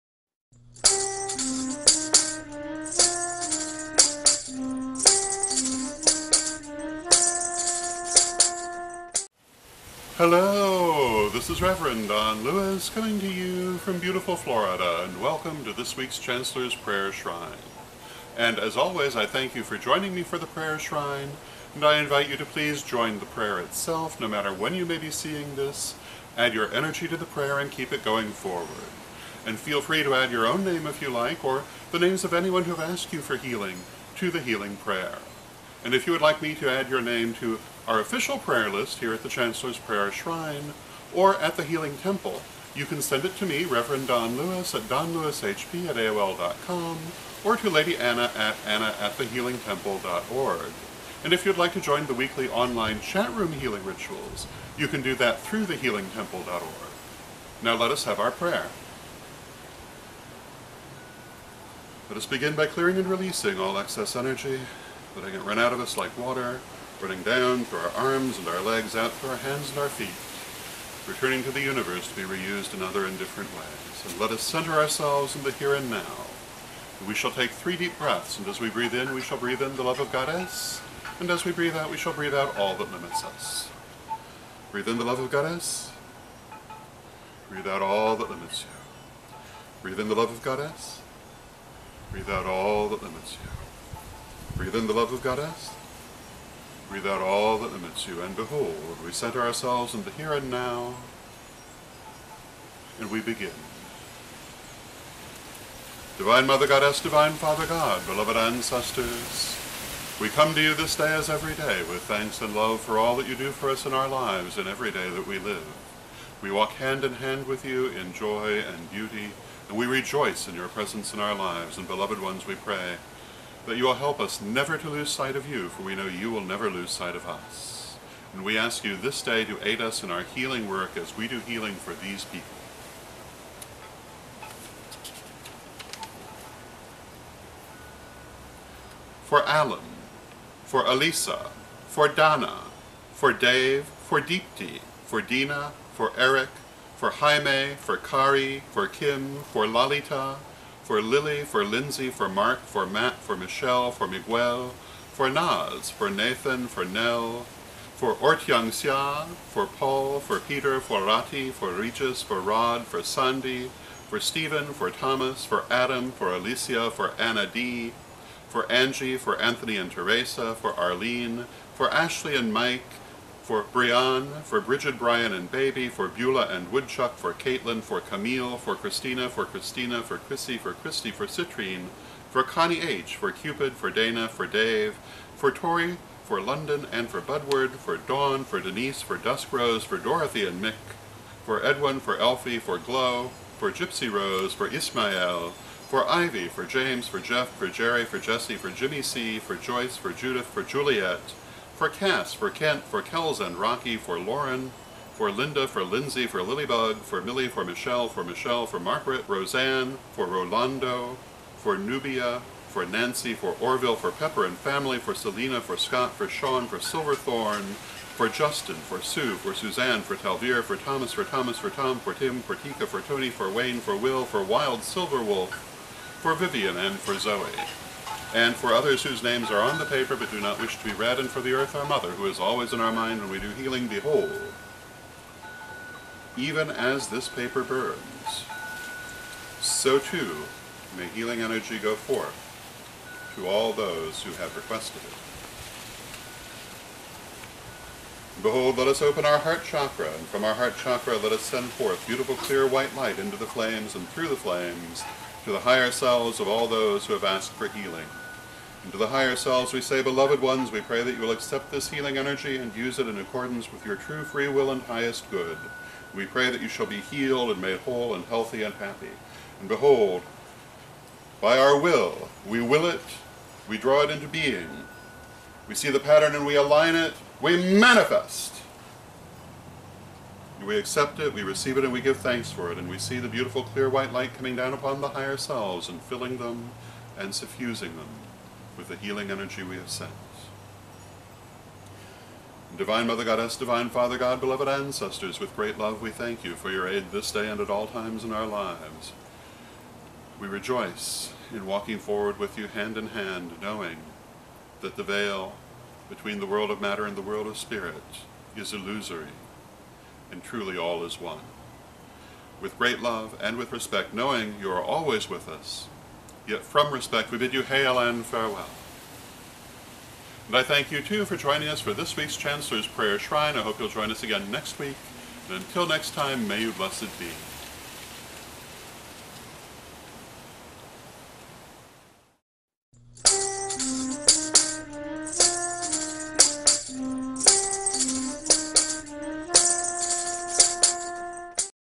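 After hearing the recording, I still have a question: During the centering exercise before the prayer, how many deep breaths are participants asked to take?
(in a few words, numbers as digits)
3.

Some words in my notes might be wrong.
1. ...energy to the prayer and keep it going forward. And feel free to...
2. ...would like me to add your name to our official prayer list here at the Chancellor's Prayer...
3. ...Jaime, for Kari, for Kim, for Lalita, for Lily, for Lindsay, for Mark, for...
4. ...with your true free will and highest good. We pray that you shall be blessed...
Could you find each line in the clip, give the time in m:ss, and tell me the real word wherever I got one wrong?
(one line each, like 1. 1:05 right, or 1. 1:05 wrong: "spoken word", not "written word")
1. 0:26 right
2. 0:36 right
3. 2:27 right
4. 4:23 wrong: "healed", not "blessed".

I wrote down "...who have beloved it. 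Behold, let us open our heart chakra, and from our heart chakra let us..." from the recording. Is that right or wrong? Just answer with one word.
wrong.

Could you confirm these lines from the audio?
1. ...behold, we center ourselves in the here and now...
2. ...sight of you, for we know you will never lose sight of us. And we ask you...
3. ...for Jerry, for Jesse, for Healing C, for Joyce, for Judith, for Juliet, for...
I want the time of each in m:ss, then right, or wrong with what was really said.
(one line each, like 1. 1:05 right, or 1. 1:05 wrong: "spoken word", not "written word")
1. 1:38 right
2. 2:05 right
3. 3:17 wrong: "Jimmy", not "Healing".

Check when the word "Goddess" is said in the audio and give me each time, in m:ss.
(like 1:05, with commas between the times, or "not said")
1:20, 1:25, 1:30, 1:35, 1:46, 4:53.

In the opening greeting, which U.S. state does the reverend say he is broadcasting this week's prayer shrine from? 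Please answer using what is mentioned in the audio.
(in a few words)
Florida.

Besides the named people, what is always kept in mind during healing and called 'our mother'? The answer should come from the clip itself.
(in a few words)
the earth.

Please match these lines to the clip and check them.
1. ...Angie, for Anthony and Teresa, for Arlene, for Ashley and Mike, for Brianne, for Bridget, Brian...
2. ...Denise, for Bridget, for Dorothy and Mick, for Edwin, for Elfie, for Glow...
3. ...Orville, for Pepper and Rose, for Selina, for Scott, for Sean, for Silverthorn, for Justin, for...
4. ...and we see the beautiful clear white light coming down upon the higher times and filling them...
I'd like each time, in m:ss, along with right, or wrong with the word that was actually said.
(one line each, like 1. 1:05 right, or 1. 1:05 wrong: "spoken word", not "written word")
1. 2:48 right
2. 3:08 wrong: "Duskrose", not "Bridget"
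3. 3:33 wrong: "Family", not "Rose"
4. 4:42 wrong: "selves", not "times".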